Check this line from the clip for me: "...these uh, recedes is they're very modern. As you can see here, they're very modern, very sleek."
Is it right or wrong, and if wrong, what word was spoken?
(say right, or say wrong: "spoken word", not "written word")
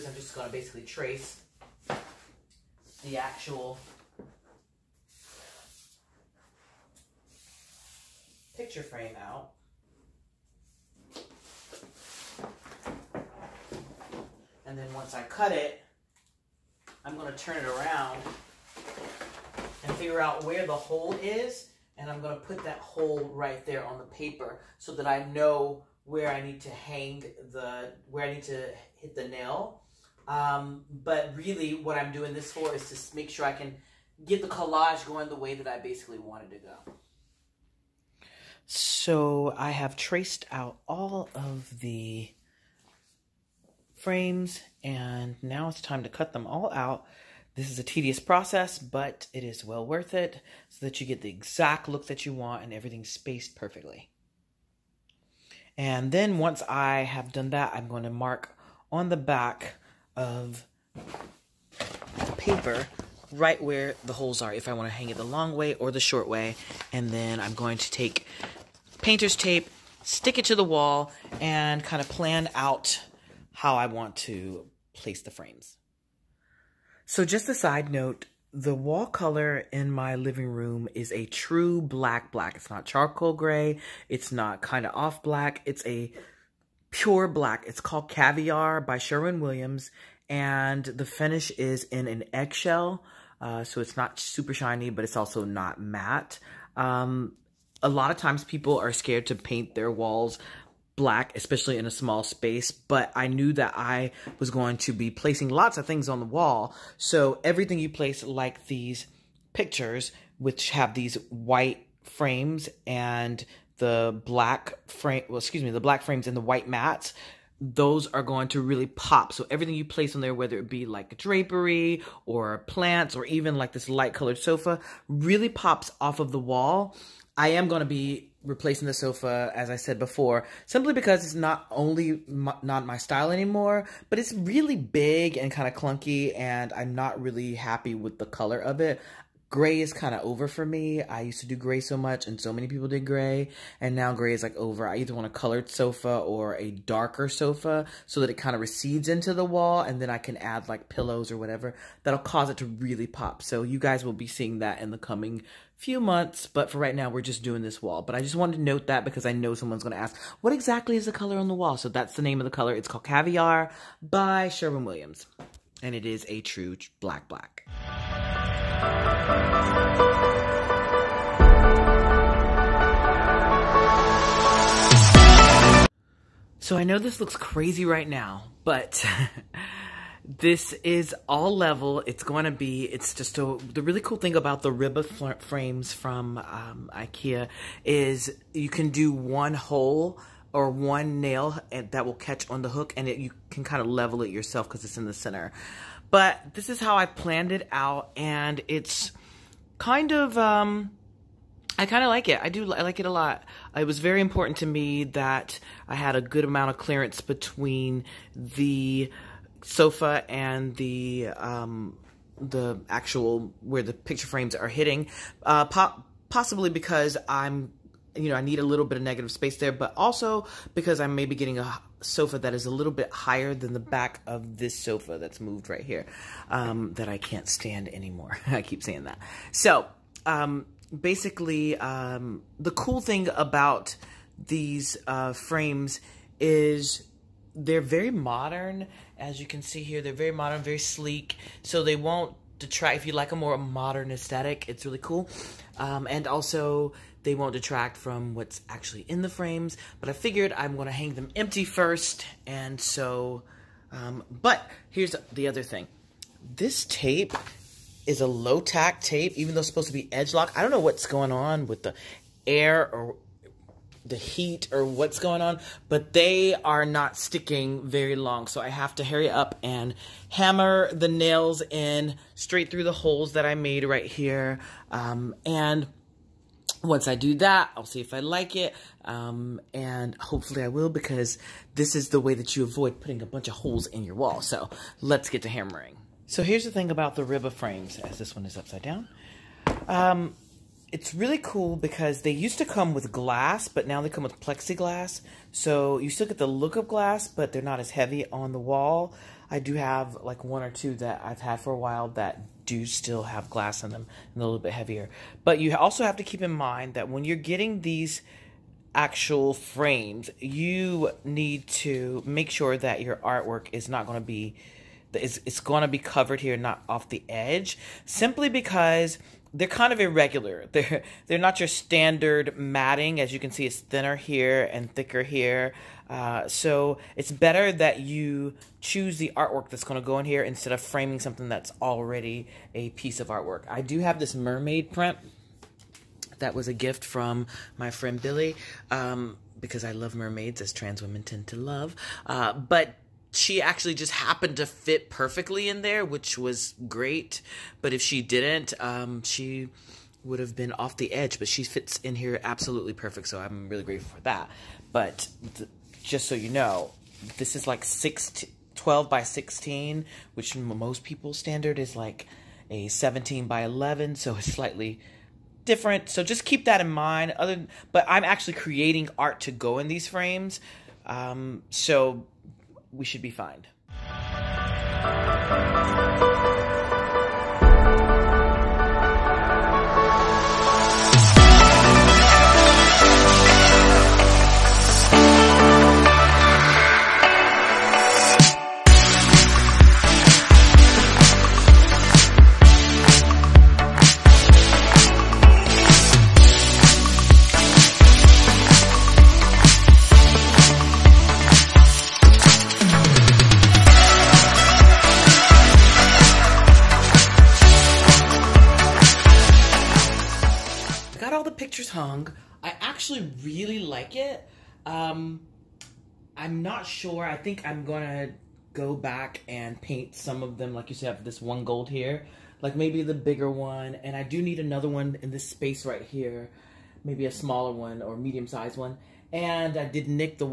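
wrong: "frames", not "recedes".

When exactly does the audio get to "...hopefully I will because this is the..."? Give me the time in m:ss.
4:40.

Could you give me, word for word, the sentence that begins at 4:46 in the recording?
So here's the thing about the of frames, as this one is upside down.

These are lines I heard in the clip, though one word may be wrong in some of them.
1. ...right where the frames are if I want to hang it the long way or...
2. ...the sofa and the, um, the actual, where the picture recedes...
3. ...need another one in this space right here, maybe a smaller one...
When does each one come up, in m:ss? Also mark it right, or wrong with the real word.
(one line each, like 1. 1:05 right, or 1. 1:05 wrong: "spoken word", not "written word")
1. 1:03 wrong: "holes", not "frames"
2. 3:28 wrong: "frames", not "recedes"
3. 7:04 right.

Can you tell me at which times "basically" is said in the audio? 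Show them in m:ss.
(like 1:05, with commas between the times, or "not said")
0:00, 0:35, 3:50.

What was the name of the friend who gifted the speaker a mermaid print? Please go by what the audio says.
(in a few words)
Billy.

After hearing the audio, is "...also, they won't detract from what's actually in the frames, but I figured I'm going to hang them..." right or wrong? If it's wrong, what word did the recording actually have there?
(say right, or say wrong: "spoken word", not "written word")
right.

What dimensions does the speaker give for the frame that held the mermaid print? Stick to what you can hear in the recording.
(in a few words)
12 by 16.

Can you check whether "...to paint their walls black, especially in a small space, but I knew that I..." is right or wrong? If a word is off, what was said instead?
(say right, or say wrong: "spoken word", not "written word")
right.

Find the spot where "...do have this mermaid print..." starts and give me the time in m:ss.
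5:33.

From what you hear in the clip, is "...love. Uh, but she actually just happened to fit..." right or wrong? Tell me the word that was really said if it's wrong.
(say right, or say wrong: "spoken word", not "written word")
right.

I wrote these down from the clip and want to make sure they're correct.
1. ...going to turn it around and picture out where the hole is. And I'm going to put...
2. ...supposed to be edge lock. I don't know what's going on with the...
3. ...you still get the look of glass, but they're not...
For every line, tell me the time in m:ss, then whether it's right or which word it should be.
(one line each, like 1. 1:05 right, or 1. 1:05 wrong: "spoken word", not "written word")
1. 0:17 wrong: "figure", not "picture"
2. 4:19 right
3. 4:55 right.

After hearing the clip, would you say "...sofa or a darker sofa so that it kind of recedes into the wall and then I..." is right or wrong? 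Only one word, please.
right.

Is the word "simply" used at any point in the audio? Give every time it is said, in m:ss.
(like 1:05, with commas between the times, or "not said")
2:10, 5:18.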